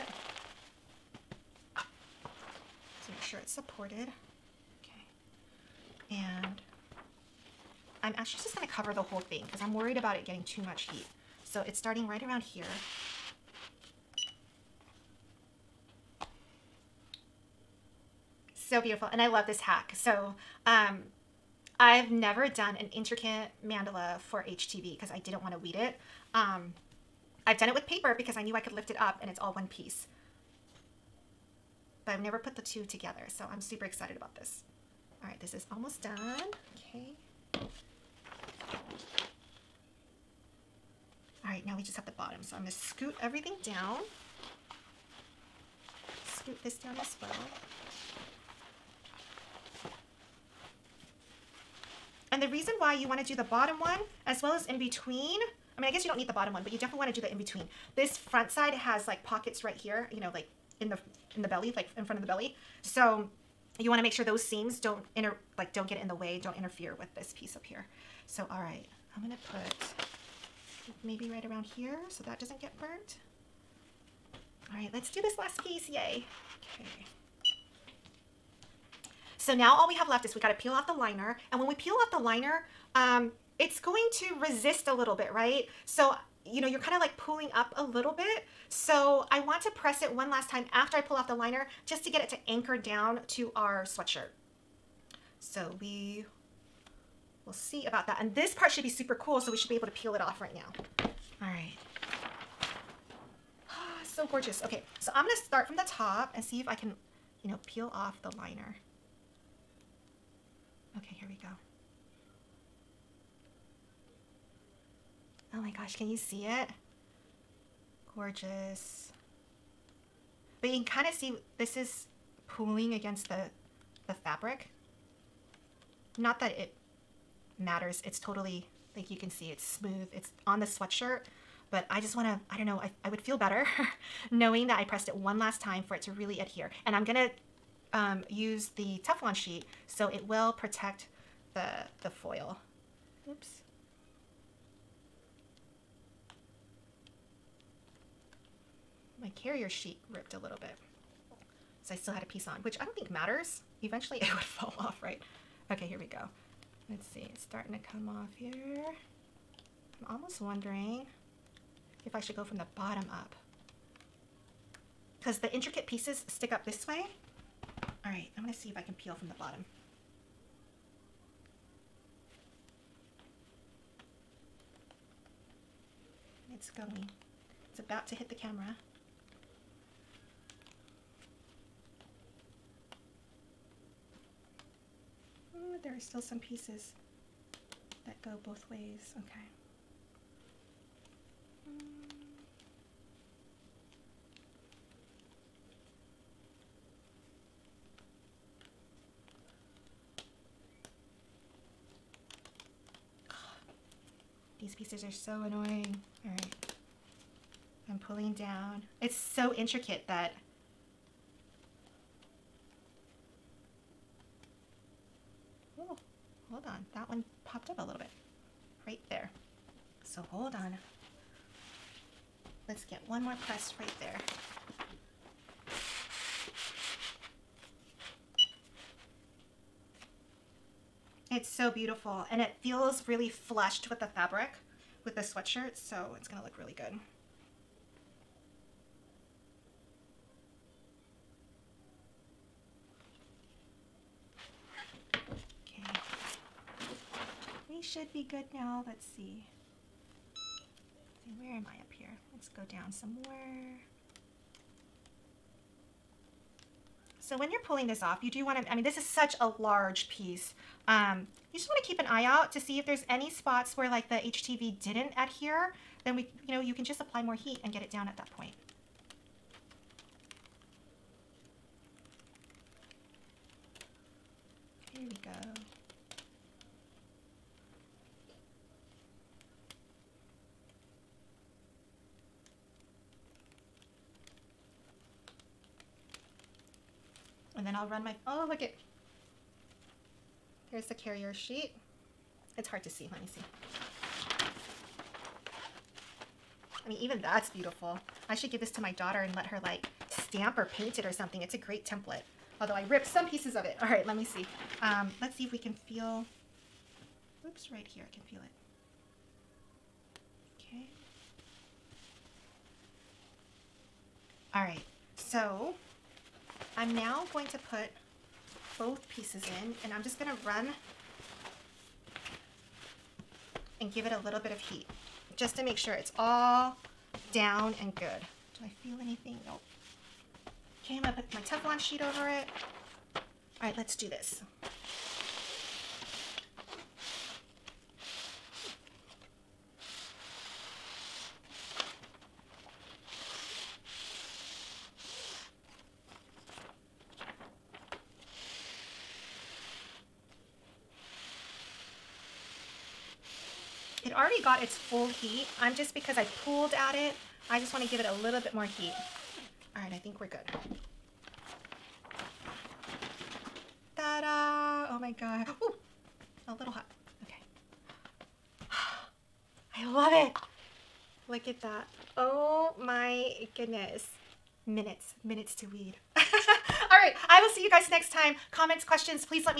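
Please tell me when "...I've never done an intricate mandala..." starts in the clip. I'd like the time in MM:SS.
00:21.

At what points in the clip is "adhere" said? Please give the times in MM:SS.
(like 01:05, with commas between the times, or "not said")
02:16, 04:25.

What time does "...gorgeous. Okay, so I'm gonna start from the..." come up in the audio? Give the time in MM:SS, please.
01:44.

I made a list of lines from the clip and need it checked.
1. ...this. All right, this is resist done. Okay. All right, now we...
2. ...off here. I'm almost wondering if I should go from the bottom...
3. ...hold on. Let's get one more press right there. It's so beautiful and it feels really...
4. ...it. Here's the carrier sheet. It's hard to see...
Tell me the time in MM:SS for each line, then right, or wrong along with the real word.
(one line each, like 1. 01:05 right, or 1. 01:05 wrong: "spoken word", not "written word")
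1. 00:34 wrong: "almost", not "resist"
2. 02:38 right
3. 03:40 right
4. 04:48 right.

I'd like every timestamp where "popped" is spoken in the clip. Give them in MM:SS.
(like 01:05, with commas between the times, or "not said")
03:37.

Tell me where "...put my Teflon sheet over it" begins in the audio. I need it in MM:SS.
05:31.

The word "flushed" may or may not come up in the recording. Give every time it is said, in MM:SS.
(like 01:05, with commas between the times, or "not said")
03:53.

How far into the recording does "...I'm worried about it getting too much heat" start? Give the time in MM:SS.
00:09.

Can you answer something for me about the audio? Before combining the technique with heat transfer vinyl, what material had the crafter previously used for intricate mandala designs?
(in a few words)
paper.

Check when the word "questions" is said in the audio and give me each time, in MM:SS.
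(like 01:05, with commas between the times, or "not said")
06:18.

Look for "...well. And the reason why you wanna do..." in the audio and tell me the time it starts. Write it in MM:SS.
00:47.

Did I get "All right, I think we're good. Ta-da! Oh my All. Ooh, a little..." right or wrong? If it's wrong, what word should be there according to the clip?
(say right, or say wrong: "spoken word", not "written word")
wrong: "God", not "All".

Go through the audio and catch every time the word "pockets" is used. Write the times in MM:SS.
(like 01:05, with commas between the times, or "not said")
00:59.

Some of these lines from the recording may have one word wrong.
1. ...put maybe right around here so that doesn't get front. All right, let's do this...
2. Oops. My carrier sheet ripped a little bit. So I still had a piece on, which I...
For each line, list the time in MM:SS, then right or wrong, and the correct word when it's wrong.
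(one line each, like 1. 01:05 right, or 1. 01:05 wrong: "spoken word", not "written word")
1. 01:09 wrong: "burnt", not "front"
2. 02:23 right.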